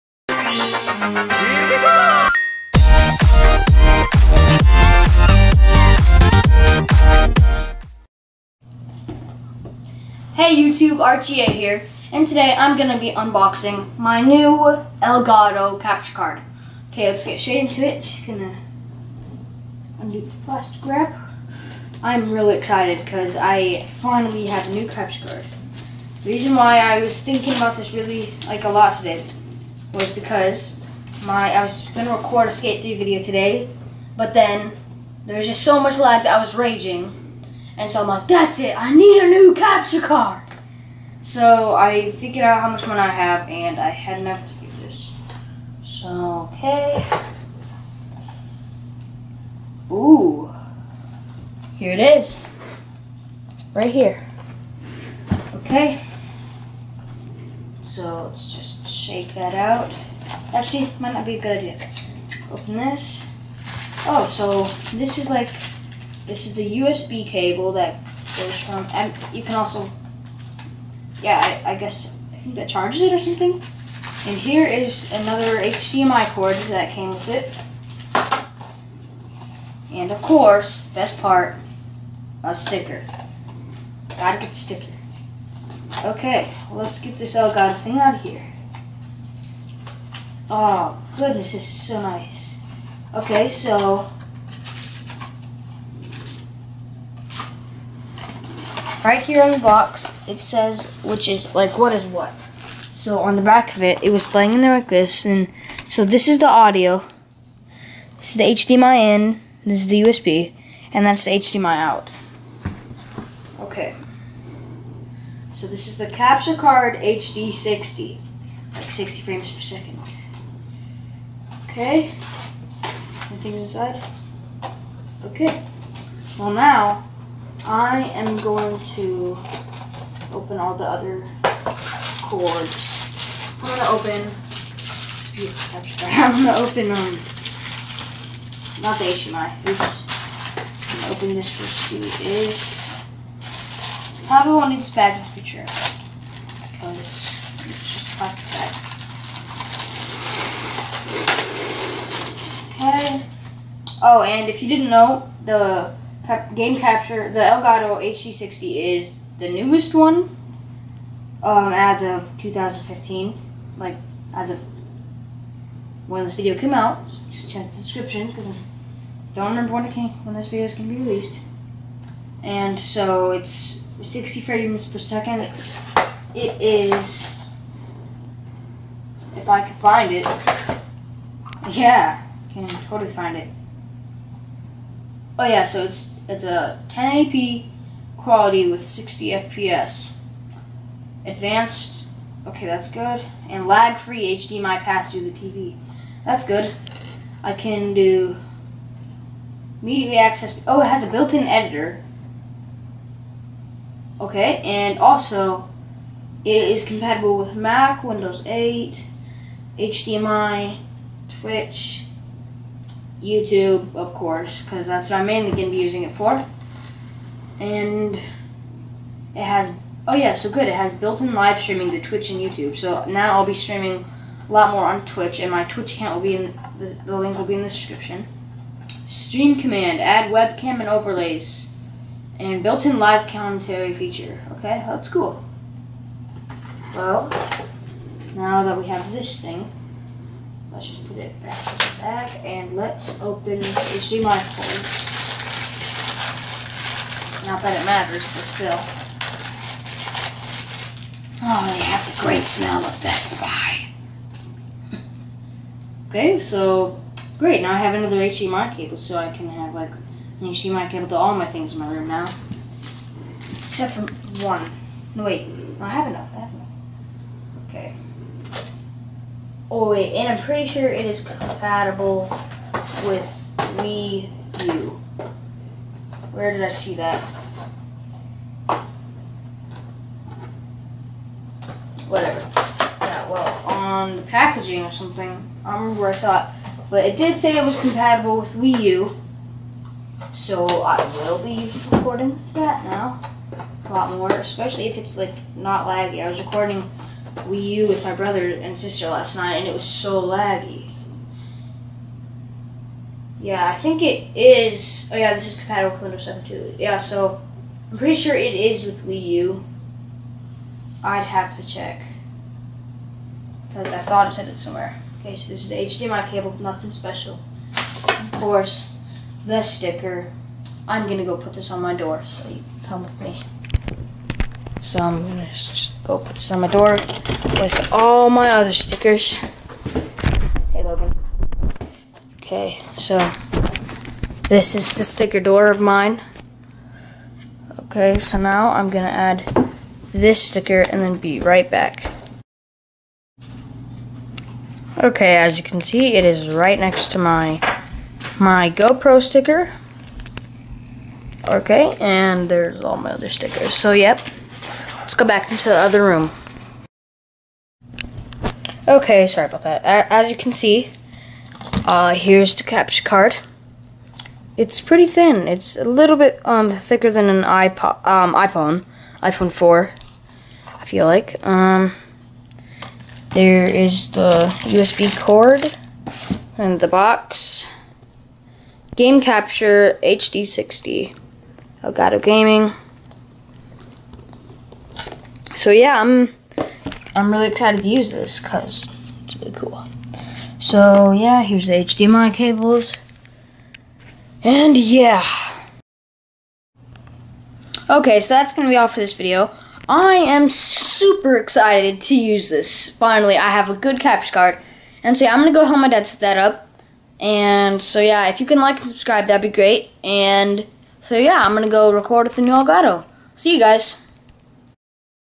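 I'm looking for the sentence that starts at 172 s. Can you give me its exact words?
And so it's 60 frames per second.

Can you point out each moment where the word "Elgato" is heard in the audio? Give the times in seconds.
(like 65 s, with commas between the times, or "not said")
15 s, 87 s, 157 s, 381 s, 412 s.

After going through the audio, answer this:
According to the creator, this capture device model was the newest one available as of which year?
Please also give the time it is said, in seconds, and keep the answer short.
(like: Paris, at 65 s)
2015, at 162 s.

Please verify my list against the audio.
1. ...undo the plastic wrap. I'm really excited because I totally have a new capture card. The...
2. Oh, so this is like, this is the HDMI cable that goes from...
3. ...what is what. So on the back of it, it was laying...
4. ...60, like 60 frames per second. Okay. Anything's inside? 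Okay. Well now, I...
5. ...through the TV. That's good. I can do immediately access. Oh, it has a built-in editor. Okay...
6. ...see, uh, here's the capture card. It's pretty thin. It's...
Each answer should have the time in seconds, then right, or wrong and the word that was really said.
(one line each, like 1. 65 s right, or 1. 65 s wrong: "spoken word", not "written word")
1. 20 s wrong: "finally", not "totally"
2. 64 s wrong: "USB", not "HDMI"
3. 101 s right
4. 117 s right
5. 195 s right
6. 360 s right.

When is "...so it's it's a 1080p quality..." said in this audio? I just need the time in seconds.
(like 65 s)
185 s.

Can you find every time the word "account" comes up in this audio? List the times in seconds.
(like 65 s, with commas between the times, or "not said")
225 s.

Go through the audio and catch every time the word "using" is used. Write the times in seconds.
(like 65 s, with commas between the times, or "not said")
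215 s.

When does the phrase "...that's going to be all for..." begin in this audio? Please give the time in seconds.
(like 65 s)
398 s.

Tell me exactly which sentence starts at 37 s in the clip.
And so I'm like, that's it, I need a new capture card.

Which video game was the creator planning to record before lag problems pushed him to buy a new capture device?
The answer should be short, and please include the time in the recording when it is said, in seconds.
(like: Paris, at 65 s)
Skate 3, at 32 s.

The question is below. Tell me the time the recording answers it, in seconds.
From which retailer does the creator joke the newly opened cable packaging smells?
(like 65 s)
253 s.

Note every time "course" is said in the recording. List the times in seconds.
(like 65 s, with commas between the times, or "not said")
80 s, 214 s, 318 s.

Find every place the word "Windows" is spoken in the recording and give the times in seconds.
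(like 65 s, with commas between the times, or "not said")
208 s, 306 s.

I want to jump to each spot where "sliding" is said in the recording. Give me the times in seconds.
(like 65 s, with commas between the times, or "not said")
not said.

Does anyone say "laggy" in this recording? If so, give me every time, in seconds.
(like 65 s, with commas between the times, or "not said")
295 s, 300 s.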